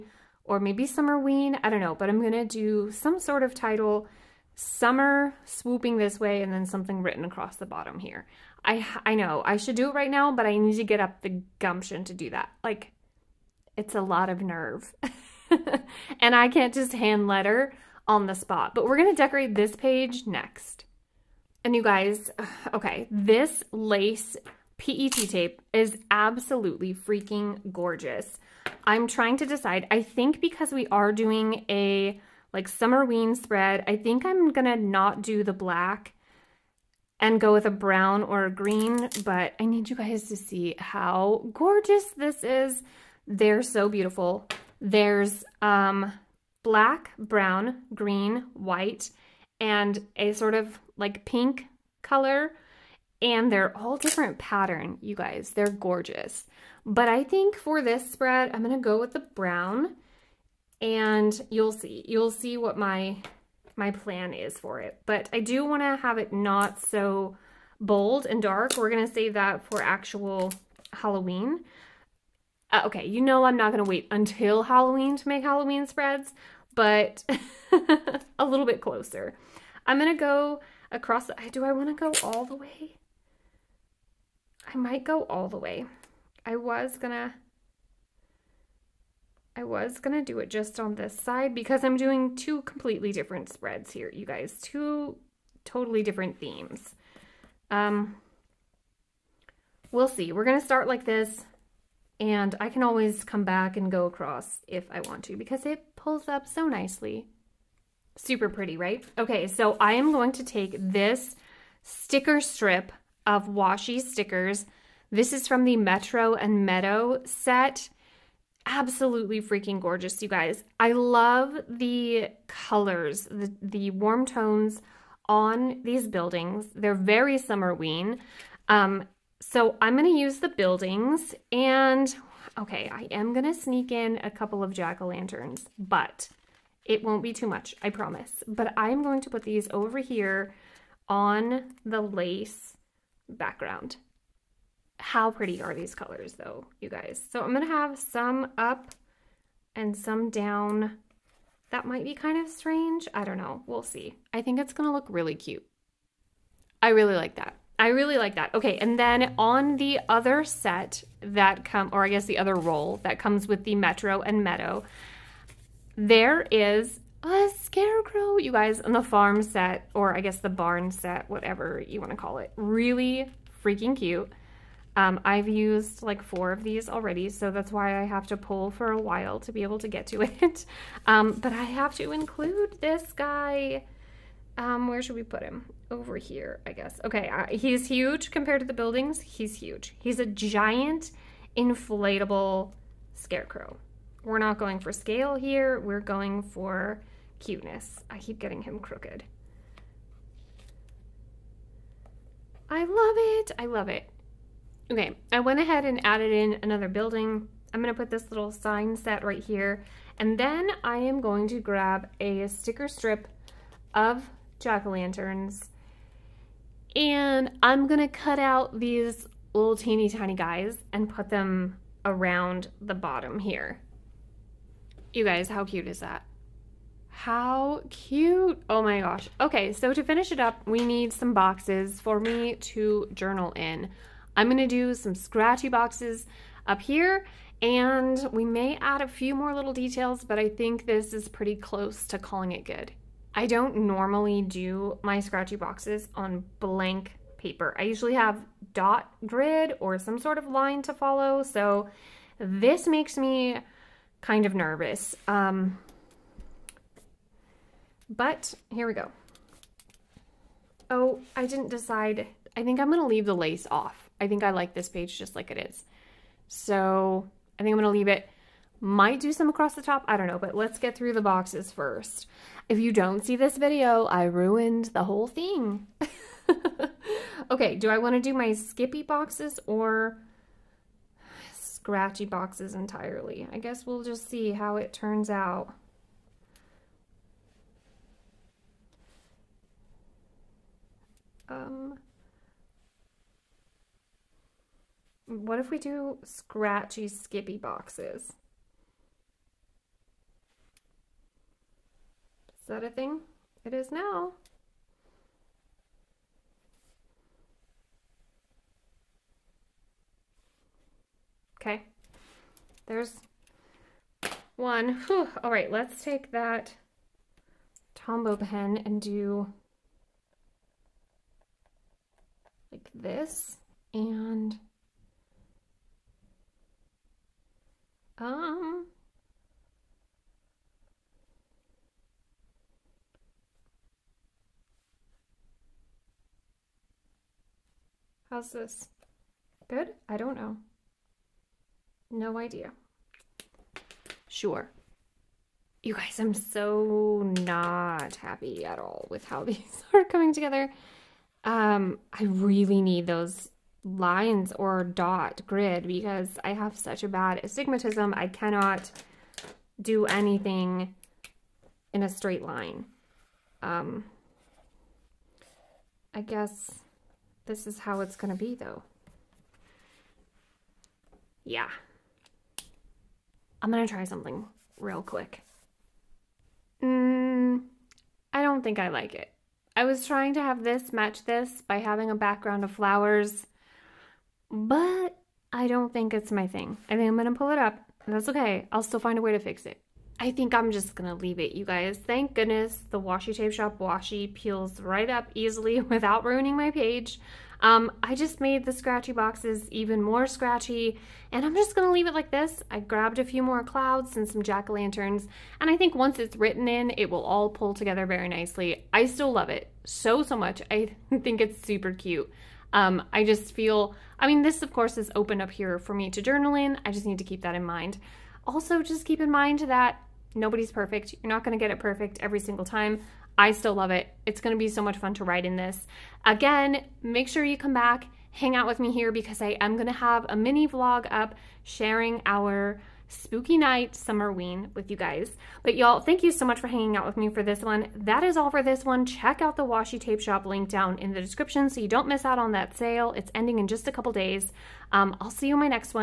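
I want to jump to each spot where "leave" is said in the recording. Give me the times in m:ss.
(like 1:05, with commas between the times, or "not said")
4:23, 4:27, 6:31, 6:41.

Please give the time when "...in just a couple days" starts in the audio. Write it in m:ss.
7:23.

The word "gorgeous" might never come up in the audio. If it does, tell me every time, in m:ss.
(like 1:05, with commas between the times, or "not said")
0:27, 0:41, 0:55, 1:59.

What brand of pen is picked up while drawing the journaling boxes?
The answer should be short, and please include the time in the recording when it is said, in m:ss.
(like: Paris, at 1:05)
Tombow, at 5:17.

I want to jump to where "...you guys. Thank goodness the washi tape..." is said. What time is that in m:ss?
6:31.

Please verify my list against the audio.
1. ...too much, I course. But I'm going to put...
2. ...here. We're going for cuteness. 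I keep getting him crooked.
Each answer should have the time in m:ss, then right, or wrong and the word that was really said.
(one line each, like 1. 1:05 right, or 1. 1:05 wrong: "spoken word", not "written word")
1. 2:17 wrong: "promise", not "course"
2. 3:15 right.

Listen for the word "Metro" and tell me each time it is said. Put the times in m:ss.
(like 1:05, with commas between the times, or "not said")
1:55, 2:43.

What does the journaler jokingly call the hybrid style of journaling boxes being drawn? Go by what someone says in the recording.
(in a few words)
Scratchy skippy boxes.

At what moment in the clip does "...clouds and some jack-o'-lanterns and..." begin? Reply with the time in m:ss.
6:43.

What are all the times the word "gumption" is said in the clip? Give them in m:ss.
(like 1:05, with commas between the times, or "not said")
0:11.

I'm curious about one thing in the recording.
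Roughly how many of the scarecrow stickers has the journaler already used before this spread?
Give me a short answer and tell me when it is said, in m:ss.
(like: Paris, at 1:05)
4, at 2:56.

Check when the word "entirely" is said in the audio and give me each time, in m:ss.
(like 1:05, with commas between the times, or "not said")
4:42.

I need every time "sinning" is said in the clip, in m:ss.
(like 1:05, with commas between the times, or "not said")
not said.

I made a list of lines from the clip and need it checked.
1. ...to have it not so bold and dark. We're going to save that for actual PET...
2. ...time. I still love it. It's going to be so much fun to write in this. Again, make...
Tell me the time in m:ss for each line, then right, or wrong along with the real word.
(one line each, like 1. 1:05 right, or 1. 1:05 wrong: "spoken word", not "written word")
1. 1:05 wrong: "Halloween", not "PET"
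2. 7:02 right.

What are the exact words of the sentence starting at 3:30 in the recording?
And then I am going to grab a sticker strip of jack-o'-lanterns.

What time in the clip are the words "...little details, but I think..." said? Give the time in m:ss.
3:59.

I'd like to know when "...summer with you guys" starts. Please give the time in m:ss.
7:13.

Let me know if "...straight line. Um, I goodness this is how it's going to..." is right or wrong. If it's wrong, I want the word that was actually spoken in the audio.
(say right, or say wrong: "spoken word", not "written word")
wrong: "guess", not "goodness".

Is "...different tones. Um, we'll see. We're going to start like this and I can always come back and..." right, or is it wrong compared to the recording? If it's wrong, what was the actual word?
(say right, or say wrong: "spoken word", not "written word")
wrong: "themes", not "tones".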